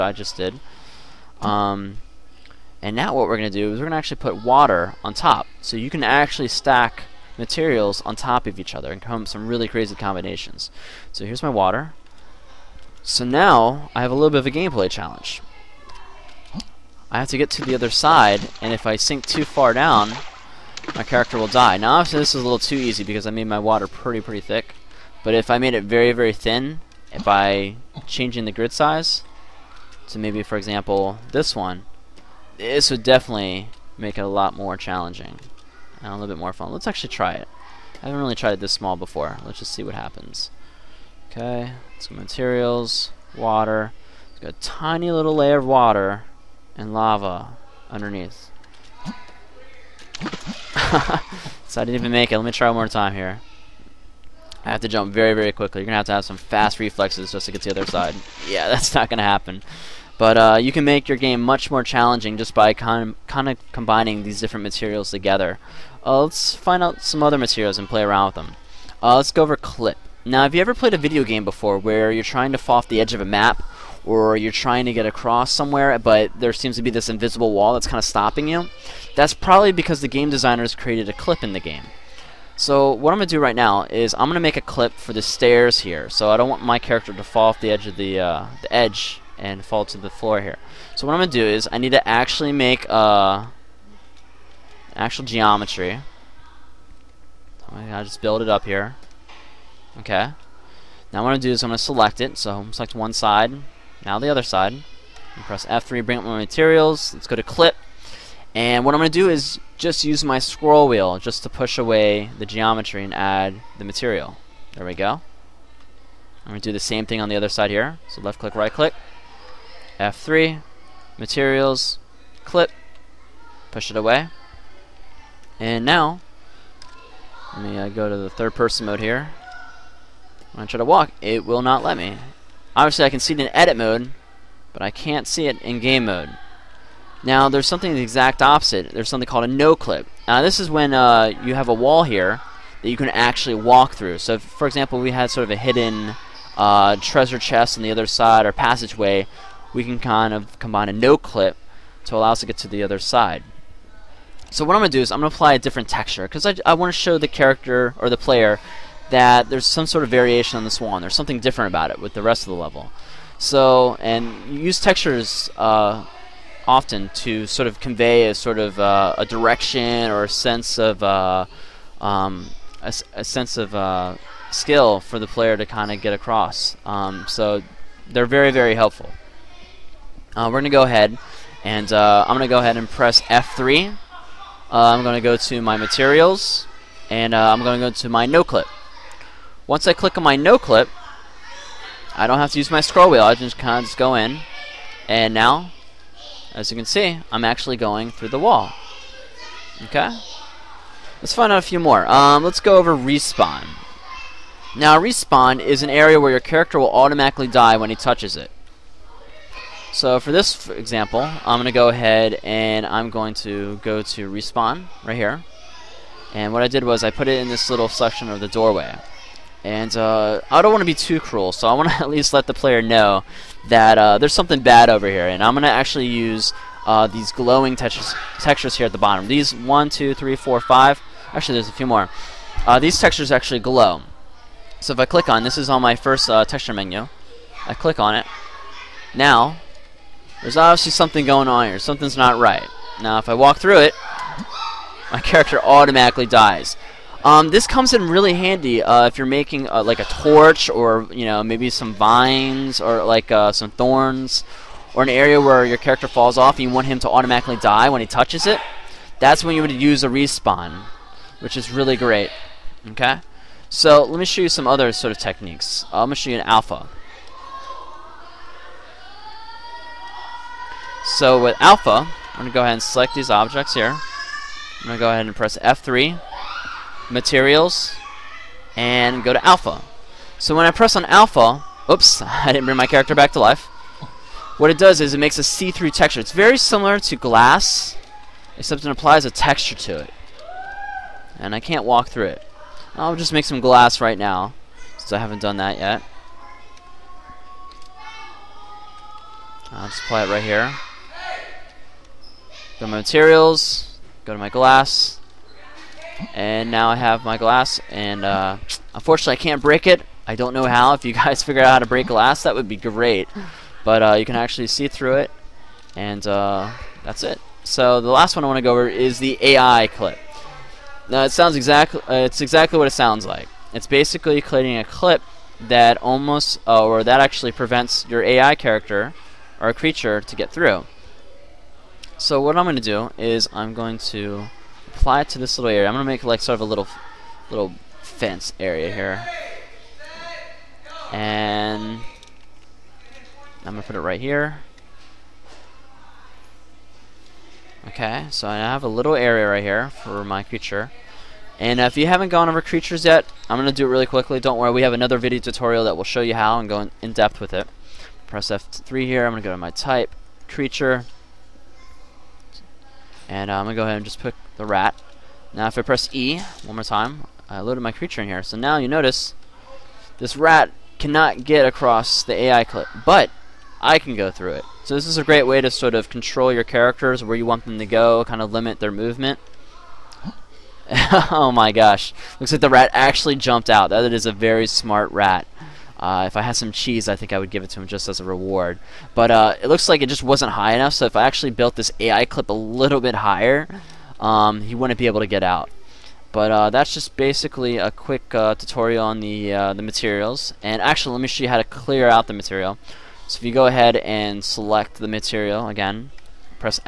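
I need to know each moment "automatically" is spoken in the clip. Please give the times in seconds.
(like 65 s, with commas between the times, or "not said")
206 s, 245 s, 257 s.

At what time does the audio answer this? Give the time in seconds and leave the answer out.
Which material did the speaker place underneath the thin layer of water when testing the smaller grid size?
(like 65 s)
46 s.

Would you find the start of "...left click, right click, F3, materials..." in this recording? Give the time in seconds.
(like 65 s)
118 s.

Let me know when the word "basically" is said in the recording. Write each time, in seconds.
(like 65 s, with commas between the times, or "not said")
323 s, 397 s.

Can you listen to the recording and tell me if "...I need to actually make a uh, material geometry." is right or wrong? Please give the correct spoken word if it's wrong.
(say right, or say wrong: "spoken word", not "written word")
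wrong: "actual", not "material".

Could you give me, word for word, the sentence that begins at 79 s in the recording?
That's probably because the game designers created a clip in the game.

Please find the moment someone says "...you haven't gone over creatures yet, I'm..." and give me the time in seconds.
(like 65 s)
351 s.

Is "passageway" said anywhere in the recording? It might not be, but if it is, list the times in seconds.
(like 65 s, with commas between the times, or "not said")
148 s.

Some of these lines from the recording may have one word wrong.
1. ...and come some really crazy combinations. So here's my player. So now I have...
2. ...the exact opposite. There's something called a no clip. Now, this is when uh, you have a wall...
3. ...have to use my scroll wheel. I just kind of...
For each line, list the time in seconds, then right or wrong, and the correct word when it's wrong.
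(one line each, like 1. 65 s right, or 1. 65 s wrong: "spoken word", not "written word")
1. 8 s wrong: "water", not "player"
2. 137 s right
3. 192 s right.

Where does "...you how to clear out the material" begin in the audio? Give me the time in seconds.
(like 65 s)
401 s.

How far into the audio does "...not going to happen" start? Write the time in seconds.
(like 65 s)
58 s.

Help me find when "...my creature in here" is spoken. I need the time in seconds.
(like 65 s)
367 s.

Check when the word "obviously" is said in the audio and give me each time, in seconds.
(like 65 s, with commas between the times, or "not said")
21 s, 132 s, 240 s.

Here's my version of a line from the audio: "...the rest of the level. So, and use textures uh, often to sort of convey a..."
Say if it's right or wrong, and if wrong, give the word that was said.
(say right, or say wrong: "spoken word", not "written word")
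right.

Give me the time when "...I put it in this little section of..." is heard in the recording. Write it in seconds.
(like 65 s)
217 s.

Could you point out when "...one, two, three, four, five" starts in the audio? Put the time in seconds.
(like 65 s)
229 s.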